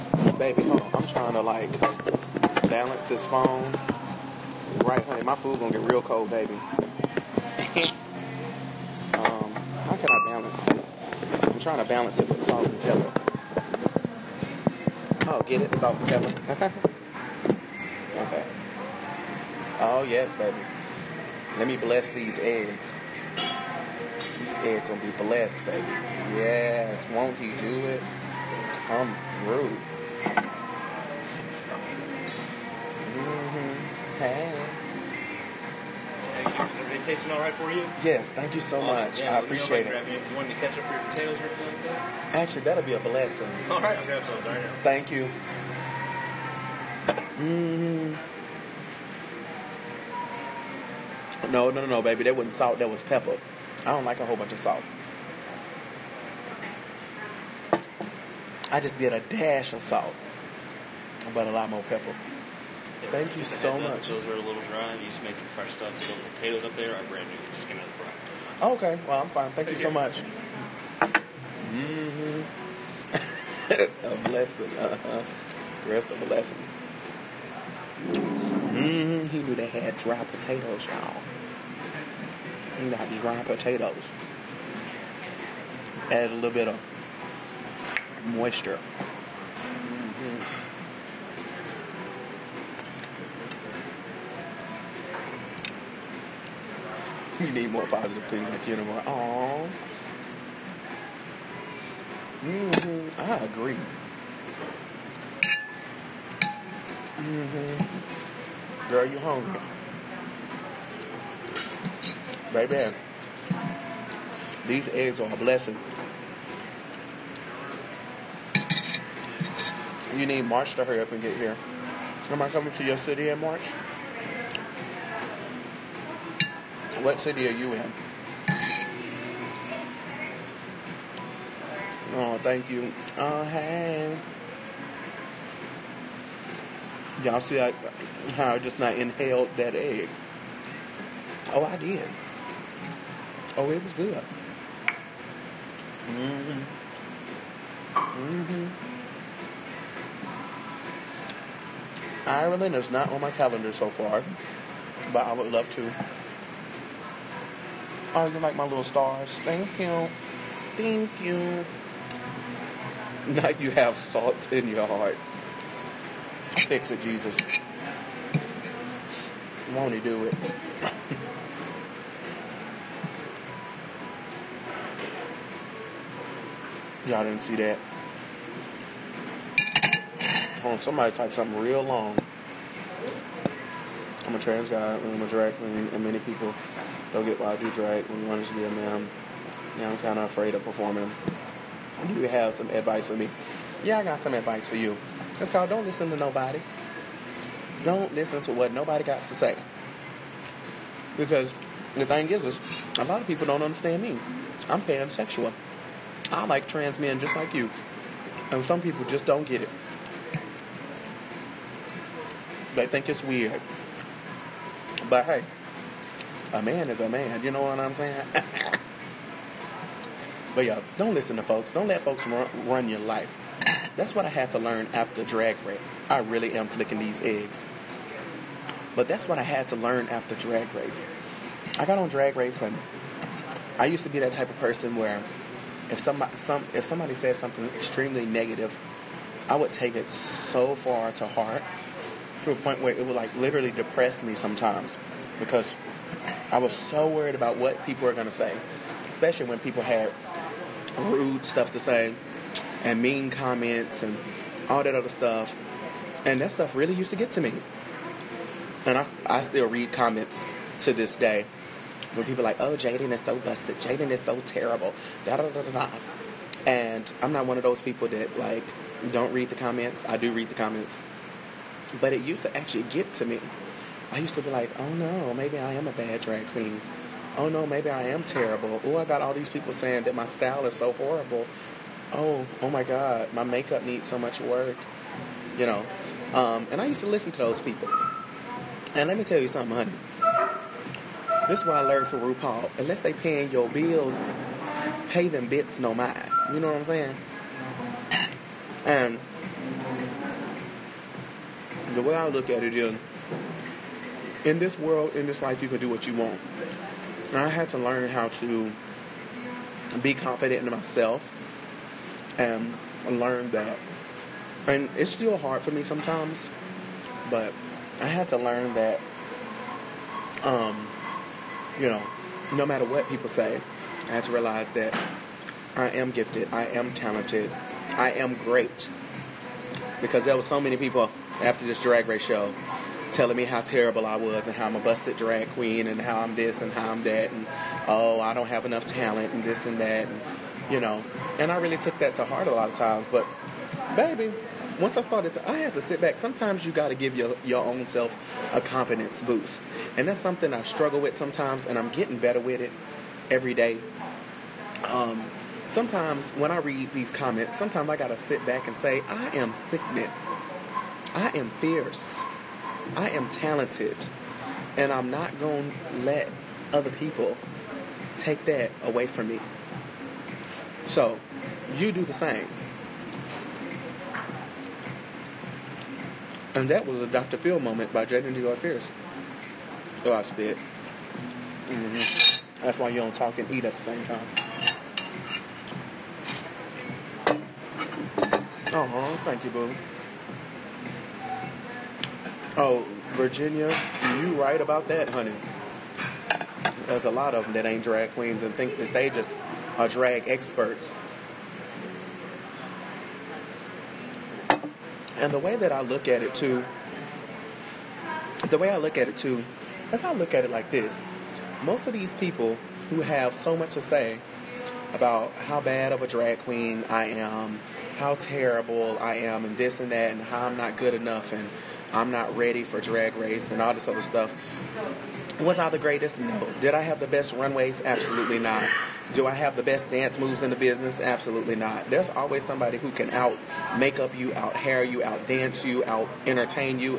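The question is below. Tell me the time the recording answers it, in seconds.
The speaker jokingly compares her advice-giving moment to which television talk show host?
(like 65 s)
377 s.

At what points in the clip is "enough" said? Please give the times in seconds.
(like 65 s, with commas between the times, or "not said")
338 s, 420 s.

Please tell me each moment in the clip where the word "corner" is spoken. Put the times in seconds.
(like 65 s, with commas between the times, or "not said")
not said.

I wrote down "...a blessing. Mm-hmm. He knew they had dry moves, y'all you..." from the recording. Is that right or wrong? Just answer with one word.
wrong.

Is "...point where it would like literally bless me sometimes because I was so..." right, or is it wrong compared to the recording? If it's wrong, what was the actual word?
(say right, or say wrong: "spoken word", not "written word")
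wrong: "depress", not "bless".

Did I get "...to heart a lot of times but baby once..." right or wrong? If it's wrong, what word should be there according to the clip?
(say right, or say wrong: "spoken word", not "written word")
right.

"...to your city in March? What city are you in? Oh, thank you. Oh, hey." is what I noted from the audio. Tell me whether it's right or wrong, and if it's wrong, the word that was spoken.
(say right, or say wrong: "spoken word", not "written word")
right.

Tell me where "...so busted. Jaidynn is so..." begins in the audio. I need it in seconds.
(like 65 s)
263 s.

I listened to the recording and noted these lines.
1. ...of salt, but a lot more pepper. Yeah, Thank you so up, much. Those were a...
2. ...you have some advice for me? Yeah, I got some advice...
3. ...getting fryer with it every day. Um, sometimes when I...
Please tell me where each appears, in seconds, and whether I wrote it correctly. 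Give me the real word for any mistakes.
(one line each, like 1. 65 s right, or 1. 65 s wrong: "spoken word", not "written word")
1. 59 s right
2. 192 s right
3. 351 s wrong: "better", not "fryer".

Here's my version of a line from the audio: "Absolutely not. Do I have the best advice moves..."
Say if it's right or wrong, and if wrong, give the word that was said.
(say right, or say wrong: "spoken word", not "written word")
wrong: "dance", not "advice".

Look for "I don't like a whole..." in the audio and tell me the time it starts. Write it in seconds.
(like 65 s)
53 s.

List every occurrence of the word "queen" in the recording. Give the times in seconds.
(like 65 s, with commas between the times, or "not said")
185 s, 276 s, 335 s, 398 s, 416 s.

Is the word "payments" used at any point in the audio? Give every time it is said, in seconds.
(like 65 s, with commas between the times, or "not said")
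not said.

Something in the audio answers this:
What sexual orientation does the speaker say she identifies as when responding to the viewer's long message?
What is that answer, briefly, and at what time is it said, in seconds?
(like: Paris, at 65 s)
Pansexual, at 204 s.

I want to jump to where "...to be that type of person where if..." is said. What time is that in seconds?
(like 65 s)
234 s.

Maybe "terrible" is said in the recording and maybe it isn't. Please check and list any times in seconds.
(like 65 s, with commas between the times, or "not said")
264 s, 278 s, 333 s, 418 s.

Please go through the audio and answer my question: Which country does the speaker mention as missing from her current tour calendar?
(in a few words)
Ireland.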